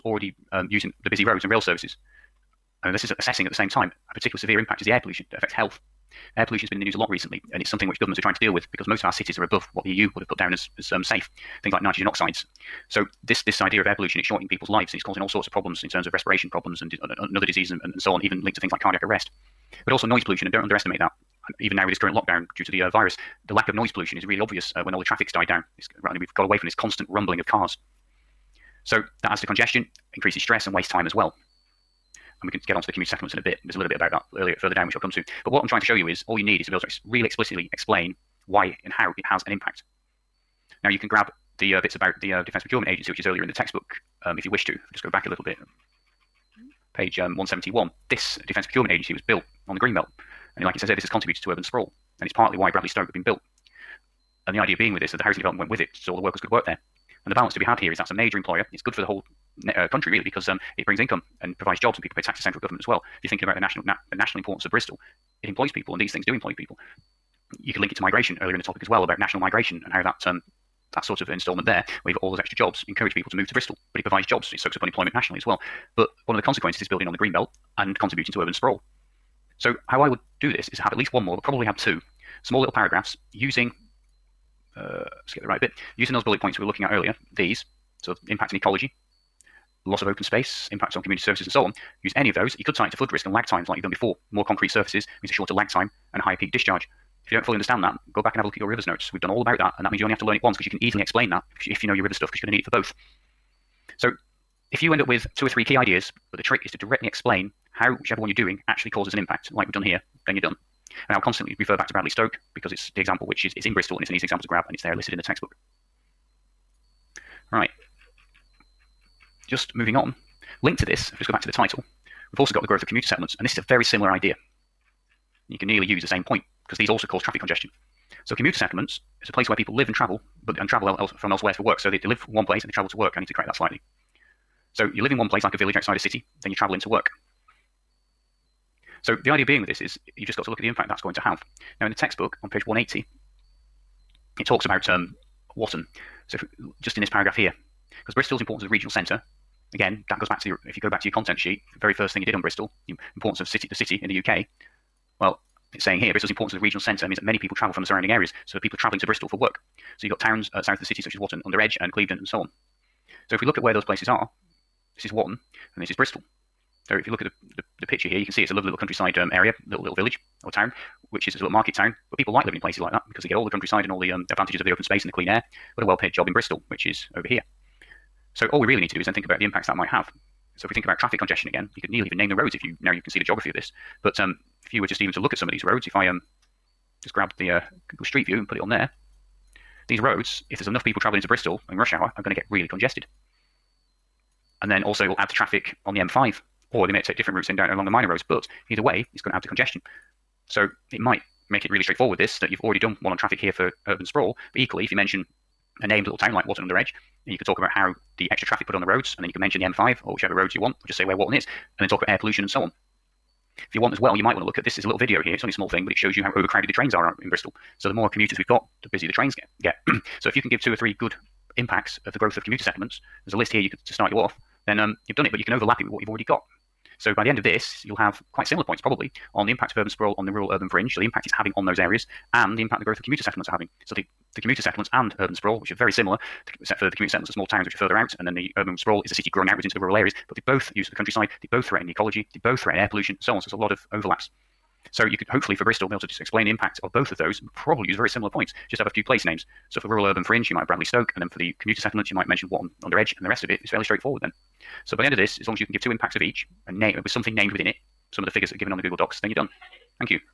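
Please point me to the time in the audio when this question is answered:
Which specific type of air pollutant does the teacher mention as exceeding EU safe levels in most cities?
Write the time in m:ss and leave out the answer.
0:11.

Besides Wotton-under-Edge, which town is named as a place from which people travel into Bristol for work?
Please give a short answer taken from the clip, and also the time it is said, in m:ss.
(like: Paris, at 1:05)
Clevedon, at 2:41.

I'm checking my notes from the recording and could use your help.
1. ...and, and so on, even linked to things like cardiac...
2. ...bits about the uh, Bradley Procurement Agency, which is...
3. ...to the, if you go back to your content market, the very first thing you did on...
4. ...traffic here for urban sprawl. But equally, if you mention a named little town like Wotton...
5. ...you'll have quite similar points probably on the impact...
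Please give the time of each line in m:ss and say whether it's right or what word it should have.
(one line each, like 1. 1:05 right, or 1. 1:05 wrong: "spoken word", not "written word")
1. 0:17 right
2. 0:41 wrong: "Defence", not "Bradley"
3. 2:30 wrong: "sheet", not "market"
4. 3:23 right
5. 3:47 right.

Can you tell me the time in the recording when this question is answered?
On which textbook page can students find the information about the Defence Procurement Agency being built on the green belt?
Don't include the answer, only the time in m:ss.
0:47.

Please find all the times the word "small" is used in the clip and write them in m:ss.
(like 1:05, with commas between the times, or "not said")
1:22, 3:35, 3:57.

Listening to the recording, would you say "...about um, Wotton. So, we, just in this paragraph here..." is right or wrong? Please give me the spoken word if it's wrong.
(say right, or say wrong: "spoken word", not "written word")
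right.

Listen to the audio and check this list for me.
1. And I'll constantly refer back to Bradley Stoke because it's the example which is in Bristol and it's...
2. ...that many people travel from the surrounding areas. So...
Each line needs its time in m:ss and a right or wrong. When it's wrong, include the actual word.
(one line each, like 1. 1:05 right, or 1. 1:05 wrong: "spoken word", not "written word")
1. 1:51 right
2. 2:37 right.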